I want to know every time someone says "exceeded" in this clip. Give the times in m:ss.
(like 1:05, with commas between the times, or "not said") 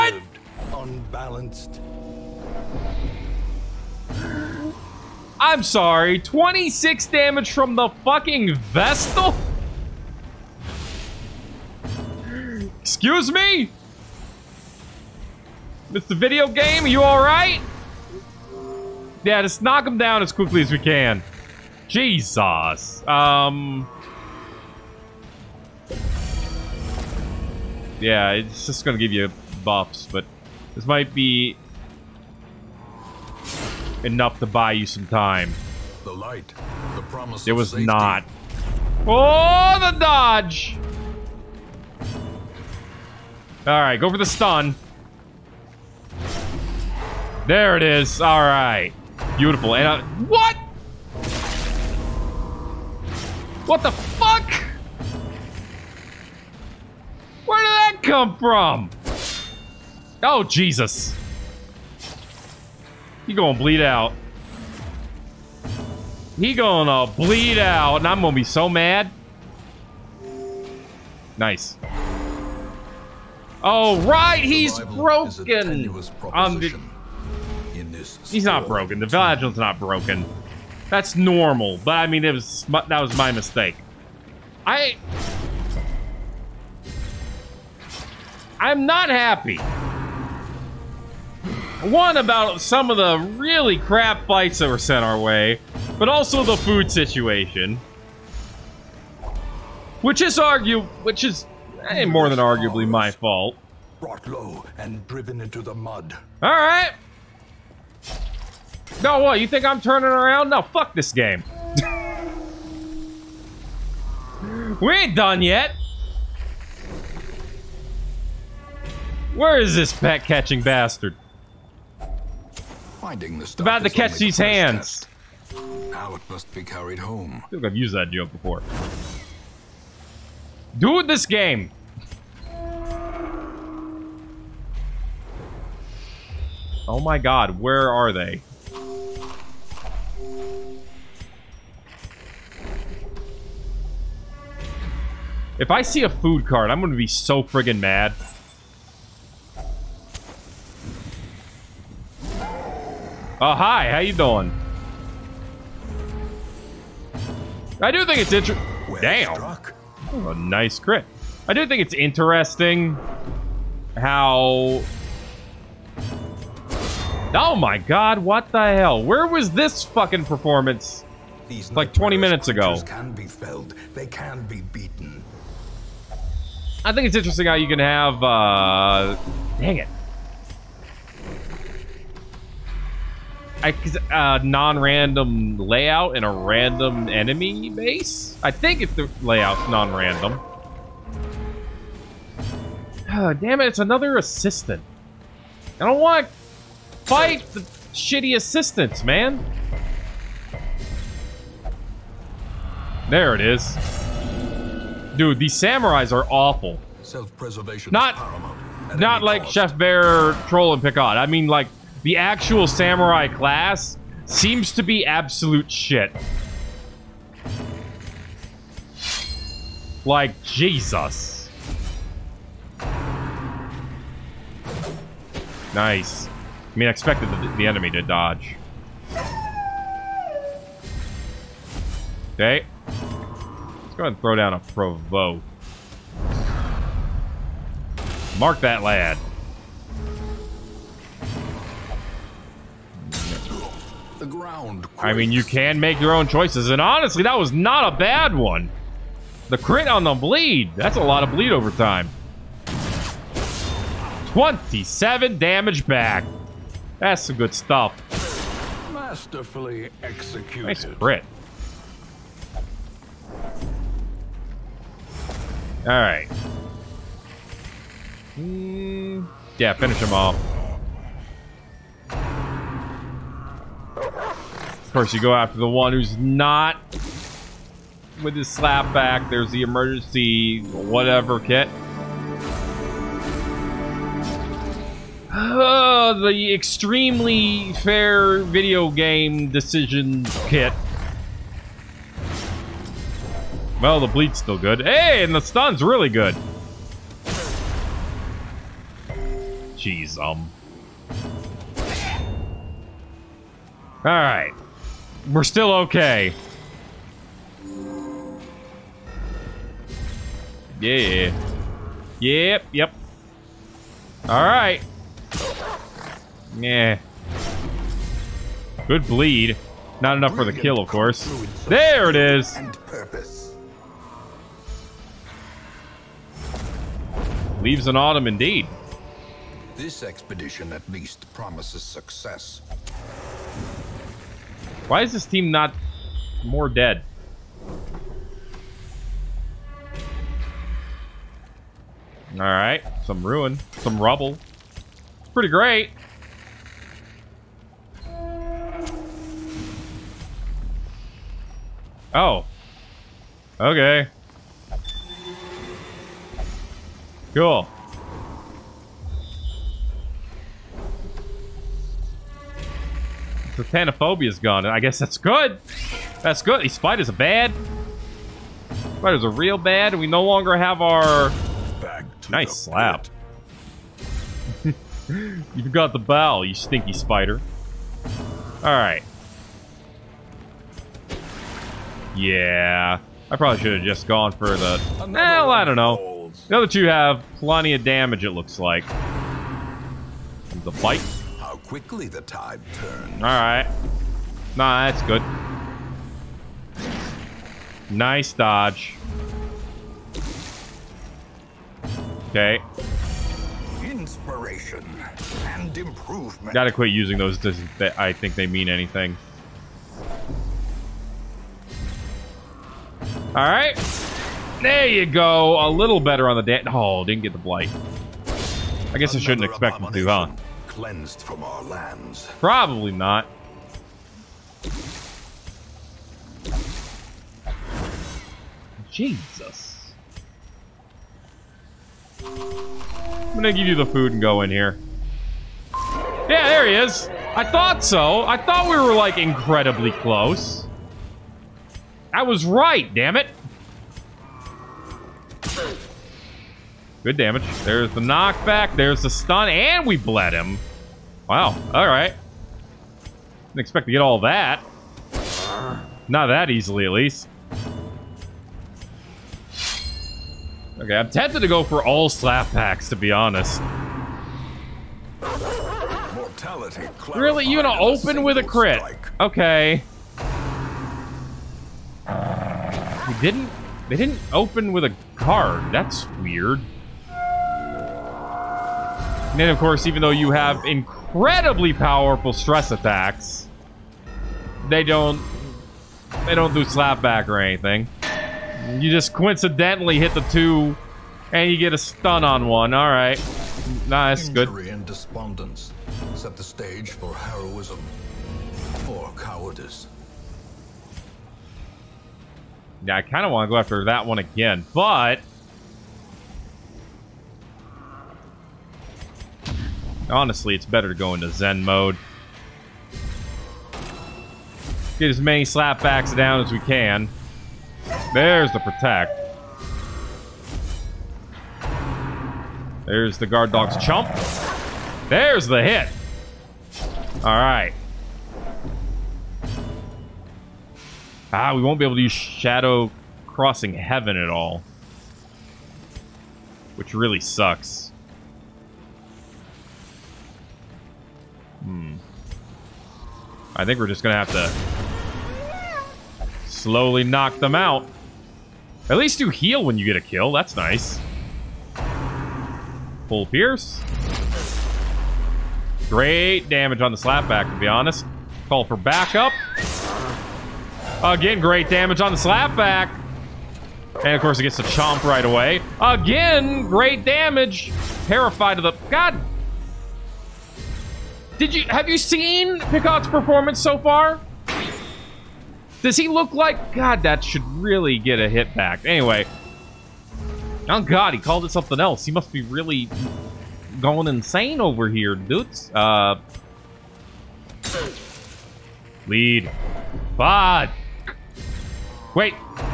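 not said.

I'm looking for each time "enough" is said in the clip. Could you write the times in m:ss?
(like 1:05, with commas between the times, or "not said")
0:34, 5:20.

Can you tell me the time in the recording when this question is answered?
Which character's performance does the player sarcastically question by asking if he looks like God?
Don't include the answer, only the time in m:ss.
9:32.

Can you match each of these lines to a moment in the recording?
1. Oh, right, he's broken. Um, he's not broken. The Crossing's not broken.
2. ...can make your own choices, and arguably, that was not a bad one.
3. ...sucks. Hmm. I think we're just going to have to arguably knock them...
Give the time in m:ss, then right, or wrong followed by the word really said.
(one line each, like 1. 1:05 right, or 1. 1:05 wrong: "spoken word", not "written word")
1. 1:13 wrong: "Vigil", not "Crossing"
2. 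4:05 wrong: "honestly", not "arguably"
3. 8:57 wrong: "slowly", not "arguably".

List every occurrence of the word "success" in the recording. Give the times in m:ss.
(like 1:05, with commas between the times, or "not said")
5:31.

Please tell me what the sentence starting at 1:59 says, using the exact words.
Where is this bat catching bastard?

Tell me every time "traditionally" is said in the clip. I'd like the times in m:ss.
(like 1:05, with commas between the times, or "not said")
not said.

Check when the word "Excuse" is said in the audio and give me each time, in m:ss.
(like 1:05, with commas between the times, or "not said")
0:12.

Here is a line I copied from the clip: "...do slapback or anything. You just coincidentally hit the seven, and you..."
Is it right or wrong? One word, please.
wrong.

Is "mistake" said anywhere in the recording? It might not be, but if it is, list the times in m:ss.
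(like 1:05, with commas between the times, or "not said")
1:23.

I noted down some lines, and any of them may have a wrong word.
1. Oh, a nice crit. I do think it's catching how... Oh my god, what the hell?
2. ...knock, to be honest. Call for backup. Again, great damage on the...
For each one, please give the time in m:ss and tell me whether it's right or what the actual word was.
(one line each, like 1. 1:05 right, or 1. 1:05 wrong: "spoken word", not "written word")
1. 2:40 wrong: "interesting", not "catching"
2. 9:16 wrong: "slapback", not "knock".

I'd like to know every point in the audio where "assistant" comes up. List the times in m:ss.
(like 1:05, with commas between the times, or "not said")
3:14, 3:18.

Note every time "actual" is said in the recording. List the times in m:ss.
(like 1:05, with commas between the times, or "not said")
3:32.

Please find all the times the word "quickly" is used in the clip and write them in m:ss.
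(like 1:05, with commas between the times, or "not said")
0:20, 6:31.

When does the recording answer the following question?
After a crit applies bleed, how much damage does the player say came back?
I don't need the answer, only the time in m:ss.
4:14.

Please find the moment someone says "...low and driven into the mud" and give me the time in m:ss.
1:44.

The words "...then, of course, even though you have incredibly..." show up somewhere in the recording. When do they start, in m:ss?
7:59.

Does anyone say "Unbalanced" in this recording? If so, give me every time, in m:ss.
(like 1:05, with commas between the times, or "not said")
0:00.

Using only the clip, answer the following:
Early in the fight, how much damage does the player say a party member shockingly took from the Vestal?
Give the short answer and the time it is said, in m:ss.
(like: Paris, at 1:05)
26, at 0:06.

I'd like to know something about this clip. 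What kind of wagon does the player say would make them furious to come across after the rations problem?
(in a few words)
Food cart.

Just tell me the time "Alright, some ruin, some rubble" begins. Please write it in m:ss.
5:42.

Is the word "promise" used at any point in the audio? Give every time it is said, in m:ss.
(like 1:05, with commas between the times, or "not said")
0:37, 5:31.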